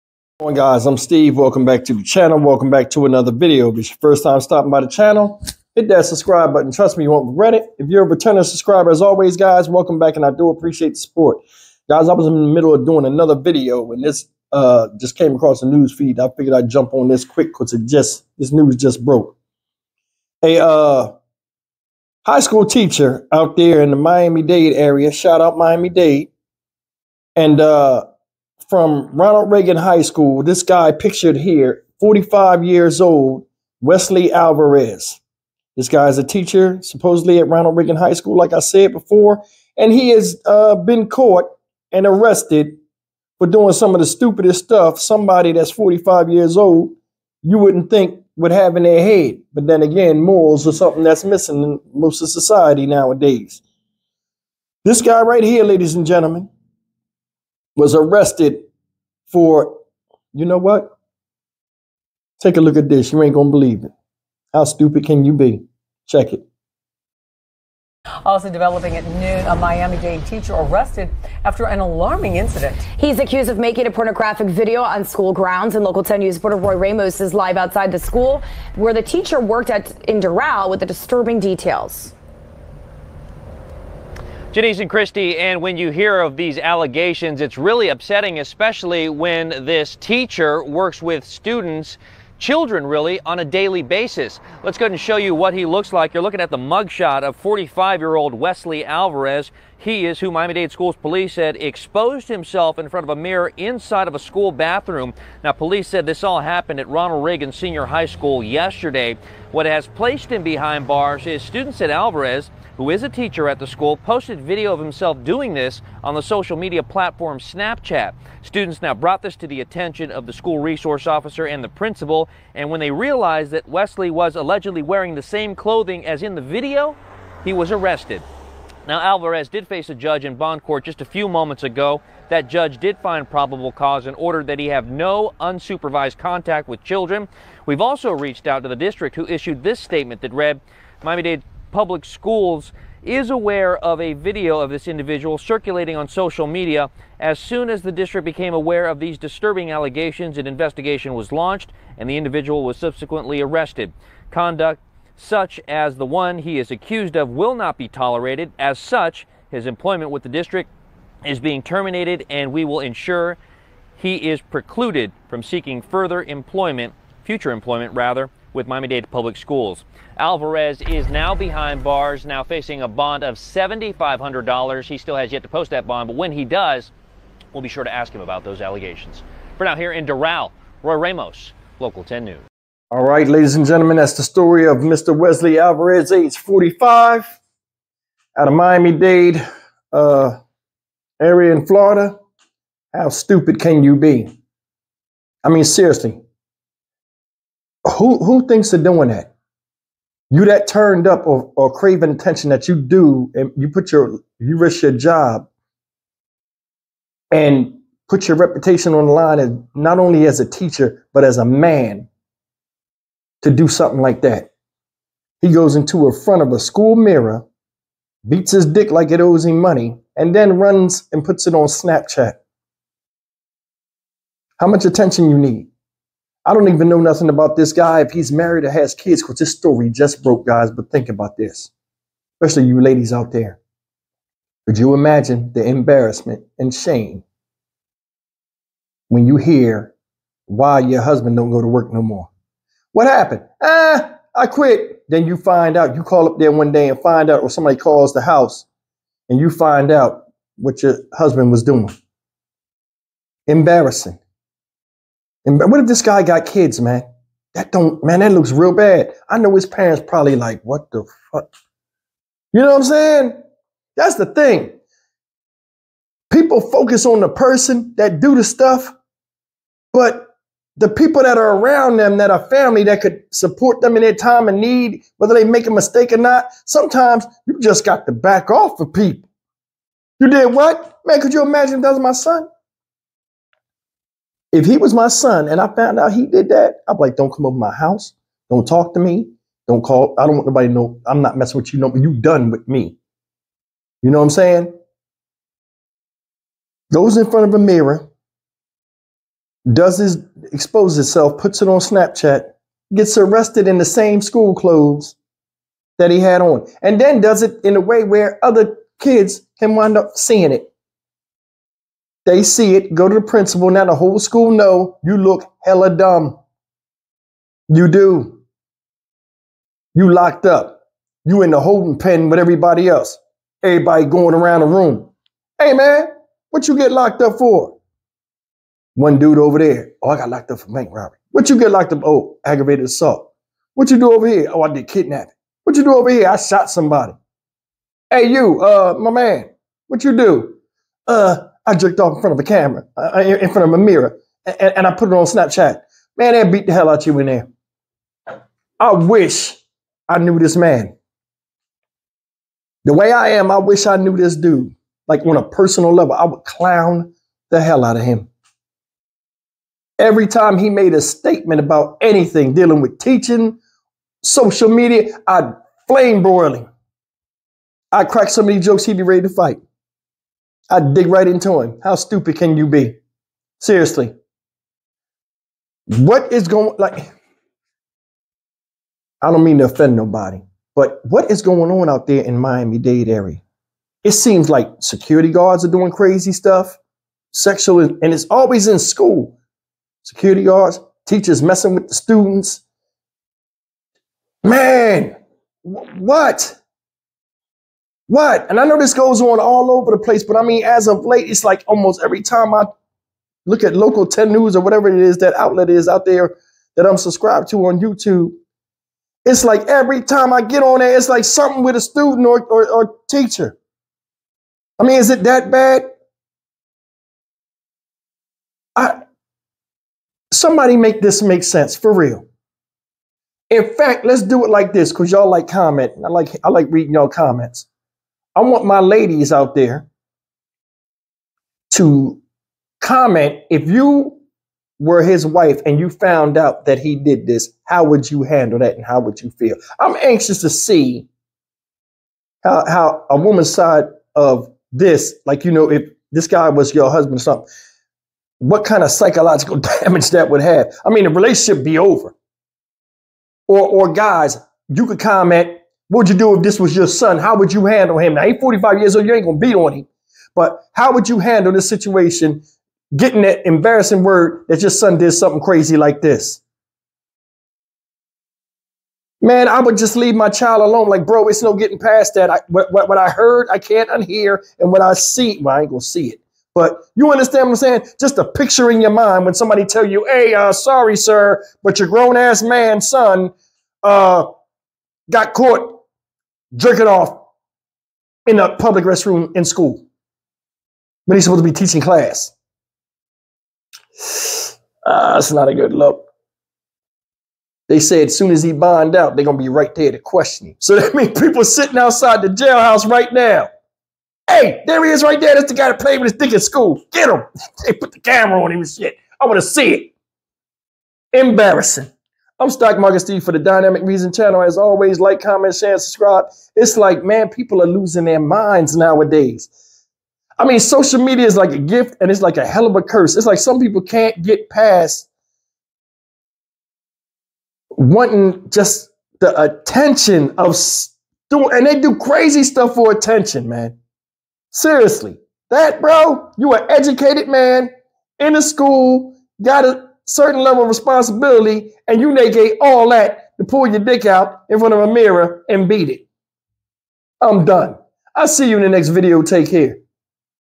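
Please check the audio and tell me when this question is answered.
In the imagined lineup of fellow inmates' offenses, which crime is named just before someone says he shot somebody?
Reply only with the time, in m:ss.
5:34.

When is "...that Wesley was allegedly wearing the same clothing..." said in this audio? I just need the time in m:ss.
2:03.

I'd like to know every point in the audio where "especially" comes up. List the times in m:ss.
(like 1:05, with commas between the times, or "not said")
1:28, 3:52.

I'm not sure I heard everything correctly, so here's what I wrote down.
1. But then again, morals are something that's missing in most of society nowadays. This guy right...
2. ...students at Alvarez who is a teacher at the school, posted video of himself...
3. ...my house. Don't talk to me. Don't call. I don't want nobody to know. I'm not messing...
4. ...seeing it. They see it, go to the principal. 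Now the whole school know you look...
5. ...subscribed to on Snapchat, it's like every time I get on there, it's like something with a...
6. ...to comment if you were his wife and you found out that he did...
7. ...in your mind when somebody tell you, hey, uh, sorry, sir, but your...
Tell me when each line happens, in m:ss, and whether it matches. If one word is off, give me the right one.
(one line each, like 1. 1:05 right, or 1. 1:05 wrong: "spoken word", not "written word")
1. 0:49 right
2. 1:51 right
3. 4:47 right
4. 5:10 right
5. 6:46 wrong: "YouTube", not "Snapchat"
6. 7:11 right
7. 7:58 right.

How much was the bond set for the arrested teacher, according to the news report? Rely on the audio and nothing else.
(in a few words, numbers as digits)
$7,500.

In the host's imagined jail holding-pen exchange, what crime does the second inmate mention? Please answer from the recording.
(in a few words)
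Aggravated assault.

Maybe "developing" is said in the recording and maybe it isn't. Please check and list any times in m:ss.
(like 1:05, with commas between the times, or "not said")
1:08.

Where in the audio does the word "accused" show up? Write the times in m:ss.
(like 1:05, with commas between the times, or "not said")
1:13, 2:36.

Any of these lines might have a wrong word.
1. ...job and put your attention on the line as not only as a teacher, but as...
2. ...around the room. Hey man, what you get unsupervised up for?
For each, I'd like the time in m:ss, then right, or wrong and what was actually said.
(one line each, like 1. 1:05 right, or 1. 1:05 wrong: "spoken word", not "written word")
1. 3:24 wrong: "reputation", not "attention"
2. 5:24 wrong: "locked", not "unsupervised".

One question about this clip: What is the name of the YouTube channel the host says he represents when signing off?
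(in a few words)
Dynamic Reason.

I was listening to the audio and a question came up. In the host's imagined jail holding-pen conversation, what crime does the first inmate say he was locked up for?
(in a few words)
Bank robbery.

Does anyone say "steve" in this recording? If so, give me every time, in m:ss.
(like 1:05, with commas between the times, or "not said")
0:00, 8:33.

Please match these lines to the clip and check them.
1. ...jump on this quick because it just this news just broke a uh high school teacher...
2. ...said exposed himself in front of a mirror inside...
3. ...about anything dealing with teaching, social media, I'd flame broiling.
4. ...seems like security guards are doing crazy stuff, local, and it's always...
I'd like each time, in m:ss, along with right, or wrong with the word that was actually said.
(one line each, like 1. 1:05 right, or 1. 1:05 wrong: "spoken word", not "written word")
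1. 0:16 right
2. 1:41 right
3. 6:01 right
4. 6:24 wrong: "sexual", not "local".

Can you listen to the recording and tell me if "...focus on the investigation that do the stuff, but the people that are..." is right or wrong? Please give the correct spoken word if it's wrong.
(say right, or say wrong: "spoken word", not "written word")
wrong: "person", not "investigation".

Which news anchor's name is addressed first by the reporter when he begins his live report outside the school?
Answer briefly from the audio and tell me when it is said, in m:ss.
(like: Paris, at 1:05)
Janice, at 1:24.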